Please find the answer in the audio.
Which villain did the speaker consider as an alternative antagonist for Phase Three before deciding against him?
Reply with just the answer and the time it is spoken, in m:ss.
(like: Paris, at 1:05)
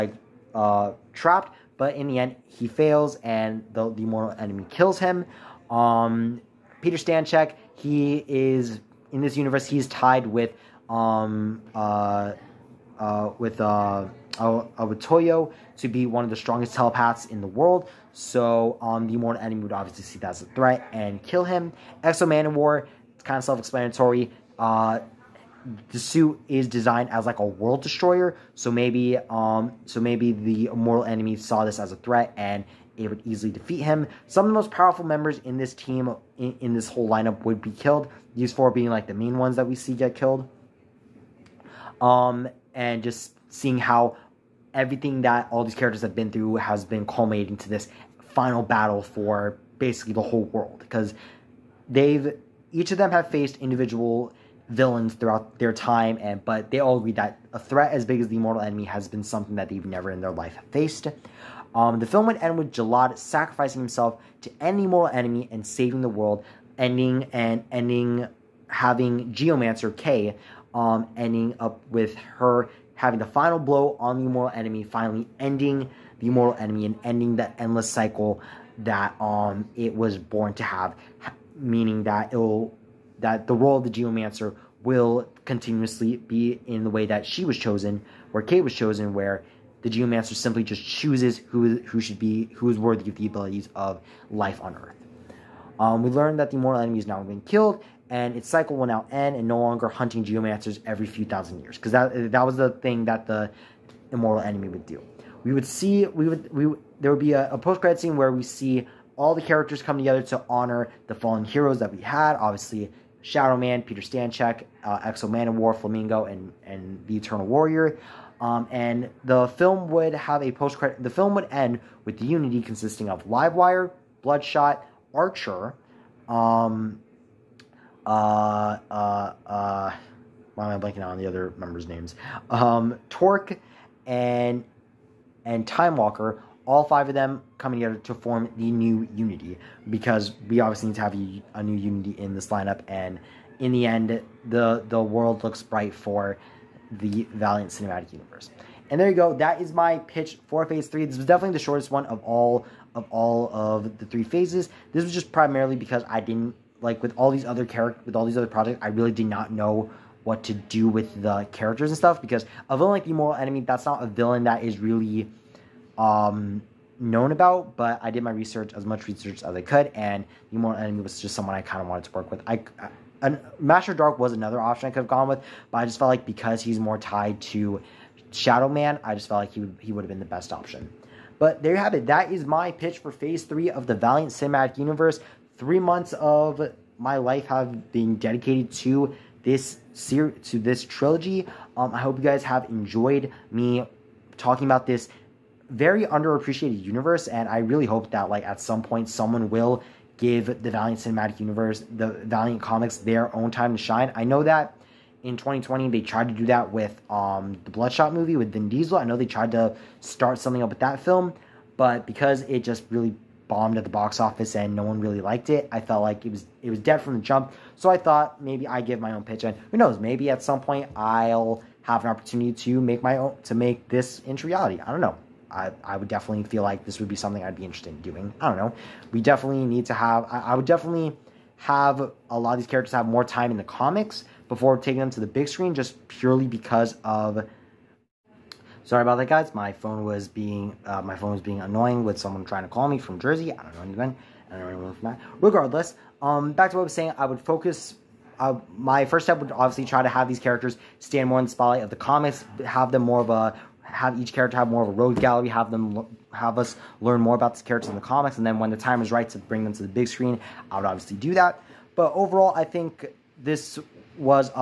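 Master Dark, at 2:53.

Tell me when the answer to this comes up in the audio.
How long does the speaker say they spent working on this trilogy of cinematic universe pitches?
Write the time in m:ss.
3:05.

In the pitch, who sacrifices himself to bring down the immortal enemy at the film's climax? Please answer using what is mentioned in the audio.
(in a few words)
Gilad.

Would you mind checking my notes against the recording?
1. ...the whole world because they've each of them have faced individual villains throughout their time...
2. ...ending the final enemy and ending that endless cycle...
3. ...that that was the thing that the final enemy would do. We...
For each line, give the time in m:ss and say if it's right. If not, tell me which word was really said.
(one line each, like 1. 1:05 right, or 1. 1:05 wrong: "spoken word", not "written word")
1. 0:50 right
2. 1:15 wrong: "immortal", not "final"
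3. 1:41 wrong: "immortal", not "final".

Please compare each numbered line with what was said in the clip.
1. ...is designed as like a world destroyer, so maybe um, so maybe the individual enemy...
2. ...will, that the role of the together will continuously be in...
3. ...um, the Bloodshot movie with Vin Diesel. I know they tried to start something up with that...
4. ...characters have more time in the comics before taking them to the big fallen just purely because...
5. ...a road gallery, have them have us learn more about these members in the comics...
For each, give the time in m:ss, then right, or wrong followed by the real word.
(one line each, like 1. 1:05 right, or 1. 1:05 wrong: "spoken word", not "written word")
1. 0:26 wrong: "immortal", not "individual"
2. 1:22 wrong: "geomancer", not "together"
3. 3:27 right
4. 3:52 wrong: "screen", not "fallen"
5. 4:14 wrong: "characters", not "members".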